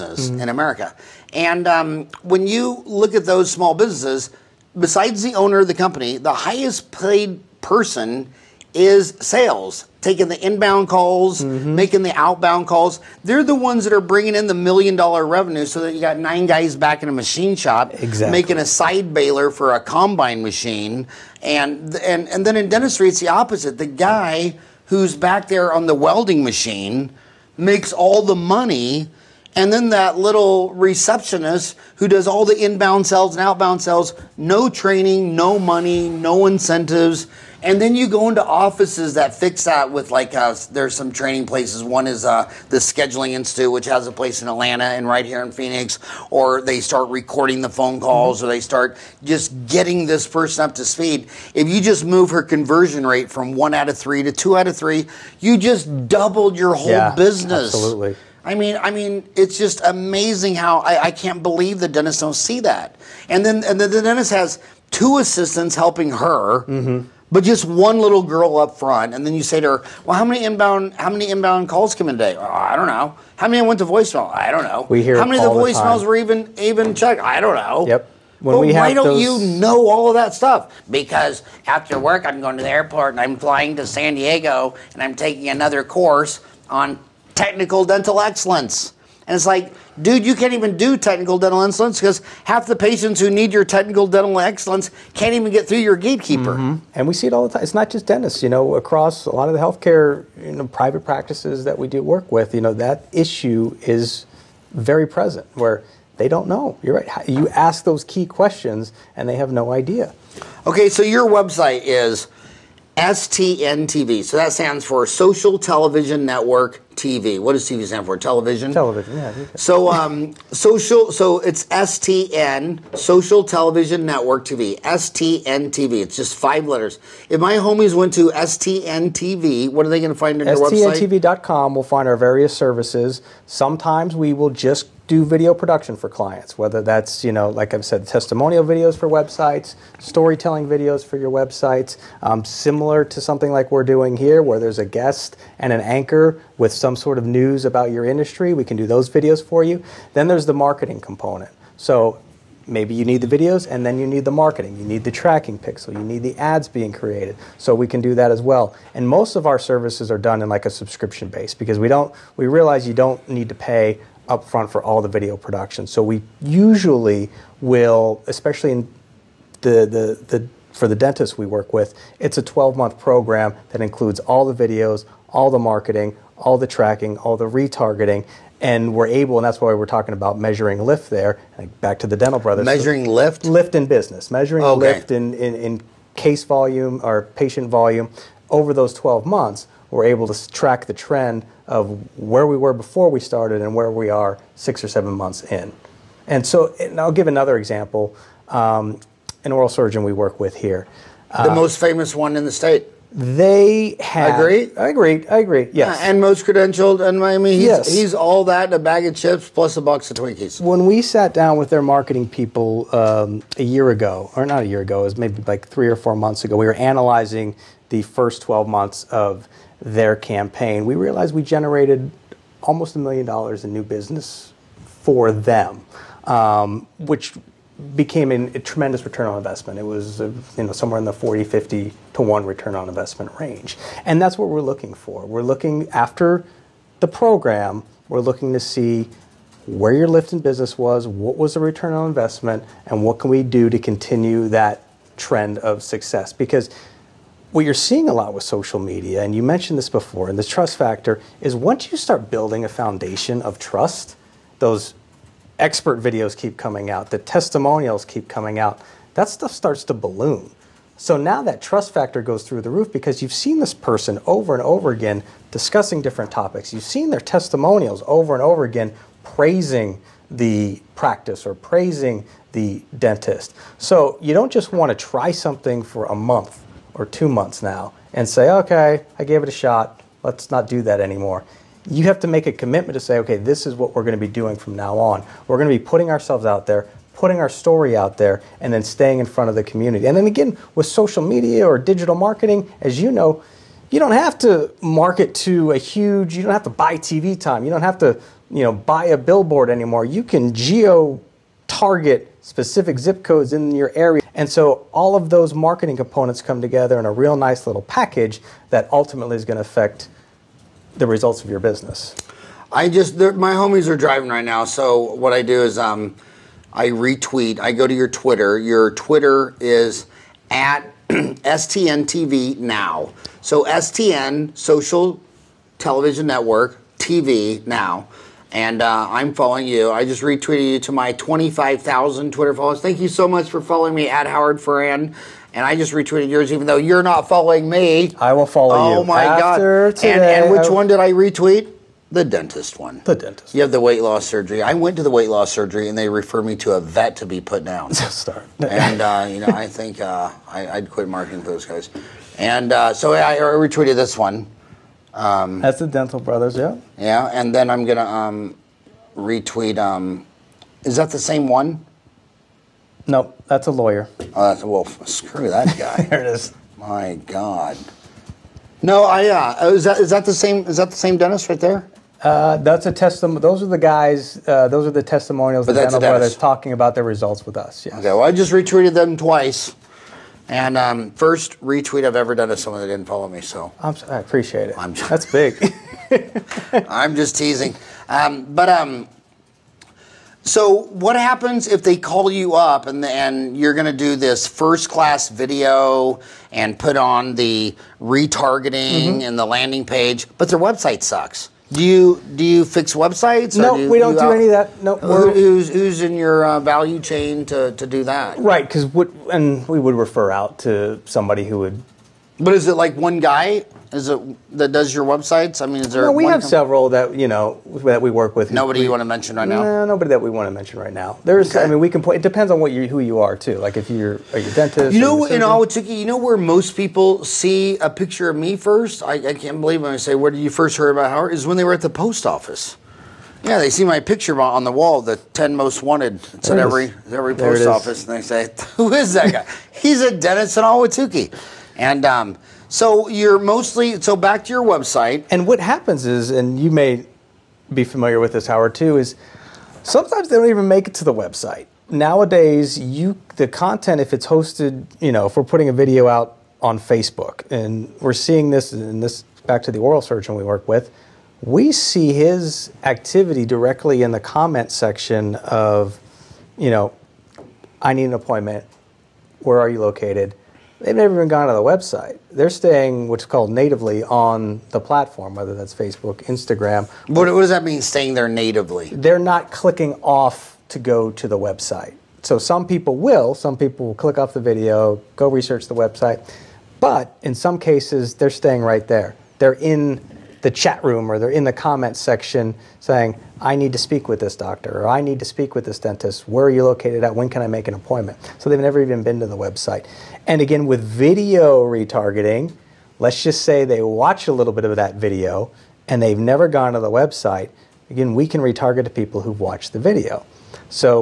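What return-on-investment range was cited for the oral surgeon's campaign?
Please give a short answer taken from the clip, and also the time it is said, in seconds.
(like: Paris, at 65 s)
40 to 50 to 1, at 231 s.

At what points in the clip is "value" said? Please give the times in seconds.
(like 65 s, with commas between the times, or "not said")
406 s.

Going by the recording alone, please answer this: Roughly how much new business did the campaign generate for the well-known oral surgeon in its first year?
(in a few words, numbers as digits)
almost a million dollars.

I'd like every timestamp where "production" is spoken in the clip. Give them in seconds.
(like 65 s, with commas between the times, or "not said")
135 s, 165 s.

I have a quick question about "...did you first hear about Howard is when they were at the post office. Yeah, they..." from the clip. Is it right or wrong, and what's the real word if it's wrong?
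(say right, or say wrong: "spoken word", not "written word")
right.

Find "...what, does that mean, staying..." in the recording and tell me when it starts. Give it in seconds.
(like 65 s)
477 s.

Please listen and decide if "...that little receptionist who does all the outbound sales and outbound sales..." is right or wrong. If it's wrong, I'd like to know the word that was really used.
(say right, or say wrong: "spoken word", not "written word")
wrong: "inbound", not "outbound".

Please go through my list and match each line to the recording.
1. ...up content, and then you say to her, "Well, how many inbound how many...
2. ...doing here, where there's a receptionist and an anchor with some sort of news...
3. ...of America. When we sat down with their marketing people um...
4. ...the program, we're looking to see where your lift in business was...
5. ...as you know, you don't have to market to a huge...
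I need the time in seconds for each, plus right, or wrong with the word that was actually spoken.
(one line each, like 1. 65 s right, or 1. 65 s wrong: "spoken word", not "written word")
1. 68 s wrong: "front", not "content"
2. 143 s wrong: "guest", not "receptionist"
3. 210 s wrong: "Twinkies", not "America"
4. 236 s right
5. 292 s right.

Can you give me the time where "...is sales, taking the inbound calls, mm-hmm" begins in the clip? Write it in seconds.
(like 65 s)
8 s.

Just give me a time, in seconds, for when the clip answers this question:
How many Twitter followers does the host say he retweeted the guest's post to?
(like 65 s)
331 s.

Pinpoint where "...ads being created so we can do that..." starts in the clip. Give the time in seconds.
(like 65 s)
156 s.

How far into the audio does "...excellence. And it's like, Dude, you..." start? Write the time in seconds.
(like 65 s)
88 s.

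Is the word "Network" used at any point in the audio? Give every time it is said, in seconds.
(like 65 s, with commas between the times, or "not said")
116 s, 124 s, 326 s.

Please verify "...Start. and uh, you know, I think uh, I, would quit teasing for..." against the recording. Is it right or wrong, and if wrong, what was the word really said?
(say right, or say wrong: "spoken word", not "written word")
wrong: "marketing", not "teasing".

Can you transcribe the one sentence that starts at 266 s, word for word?
You've seen their testimonials over and over again praising the practice or praising the dentist.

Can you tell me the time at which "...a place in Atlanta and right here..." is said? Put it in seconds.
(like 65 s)
44 s.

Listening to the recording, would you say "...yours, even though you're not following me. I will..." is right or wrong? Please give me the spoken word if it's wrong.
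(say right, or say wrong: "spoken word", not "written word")
right.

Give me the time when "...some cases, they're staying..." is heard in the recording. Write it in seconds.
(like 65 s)
487 s.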